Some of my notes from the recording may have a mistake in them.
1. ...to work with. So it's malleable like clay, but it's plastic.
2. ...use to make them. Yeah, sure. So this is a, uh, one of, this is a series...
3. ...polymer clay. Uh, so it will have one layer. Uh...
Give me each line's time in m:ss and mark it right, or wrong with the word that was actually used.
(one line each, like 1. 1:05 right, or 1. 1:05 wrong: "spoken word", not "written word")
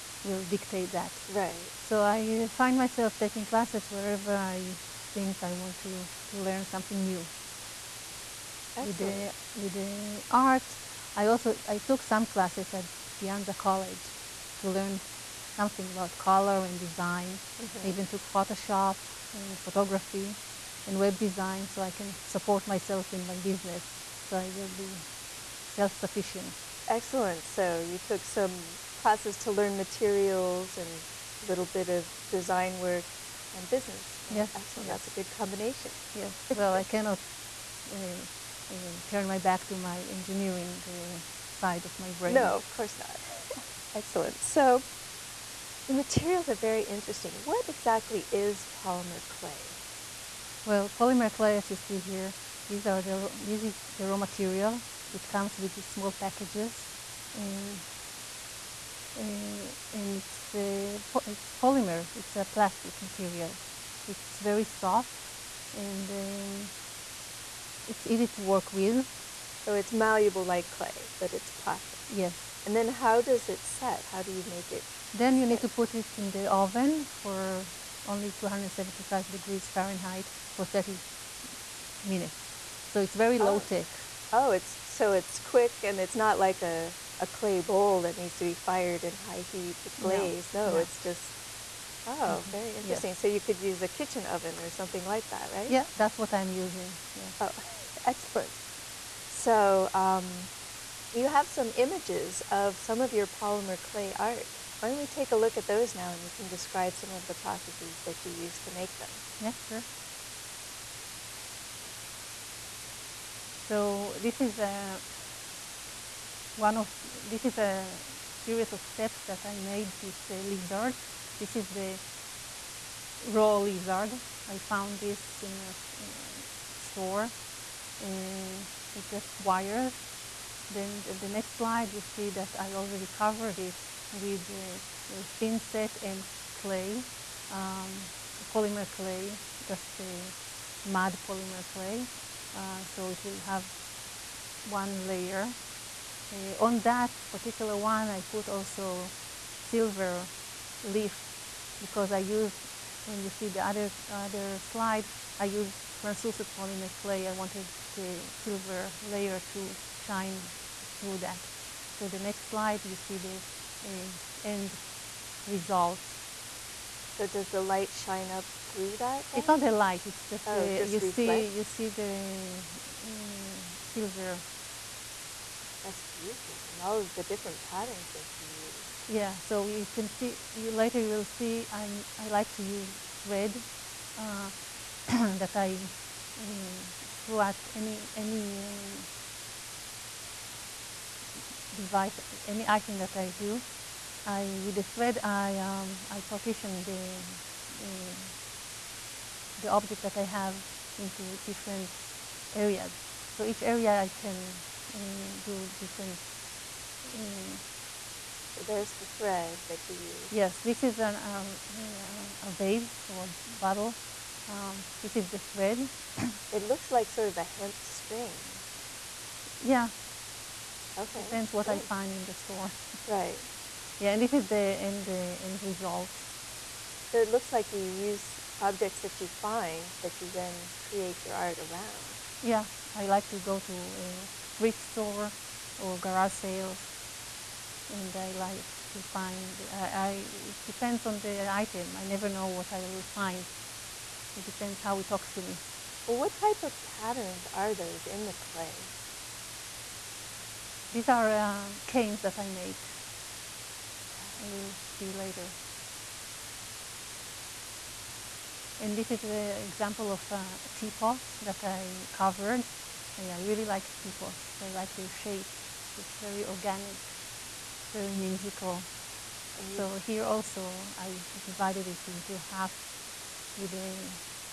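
1. 1:08 right
2. 1:48 right
3. 2:21 right.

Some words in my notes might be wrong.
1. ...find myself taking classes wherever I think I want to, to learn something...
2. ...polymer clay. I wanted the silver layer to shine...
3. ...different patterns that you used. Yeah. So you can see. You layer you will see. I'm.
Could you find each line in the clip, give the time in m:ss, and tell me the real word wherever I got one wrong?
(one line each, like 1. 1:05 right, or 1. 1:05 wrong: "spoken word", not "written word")
1. 0:02 right
2. 2:36 right
3. 2:57 wrong: "later", not "layer".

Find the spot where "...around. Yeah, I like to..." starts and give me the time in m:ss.
3:51.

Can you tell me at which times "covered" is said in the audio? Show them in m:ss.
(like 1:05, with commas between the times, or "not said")
2:13, 4:22.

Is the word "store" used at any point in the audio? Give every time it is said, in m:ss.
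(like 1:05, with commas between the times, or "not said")
2:06, 3:42, 3:54.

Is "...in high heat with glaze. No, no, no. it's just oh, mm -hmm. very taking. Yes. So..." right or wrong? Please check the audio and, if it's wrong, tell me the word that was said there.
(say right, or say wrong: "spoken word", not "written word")
wrong: "interesting", not "taking".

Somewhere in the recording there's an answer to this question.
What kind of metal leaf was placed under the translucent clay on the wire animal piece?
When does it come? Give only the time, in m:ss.
2:29.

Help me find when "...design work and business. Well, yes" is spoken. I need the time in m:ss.
0:32.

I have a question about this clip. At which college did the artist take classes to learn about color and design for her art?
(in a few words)
De Anza College.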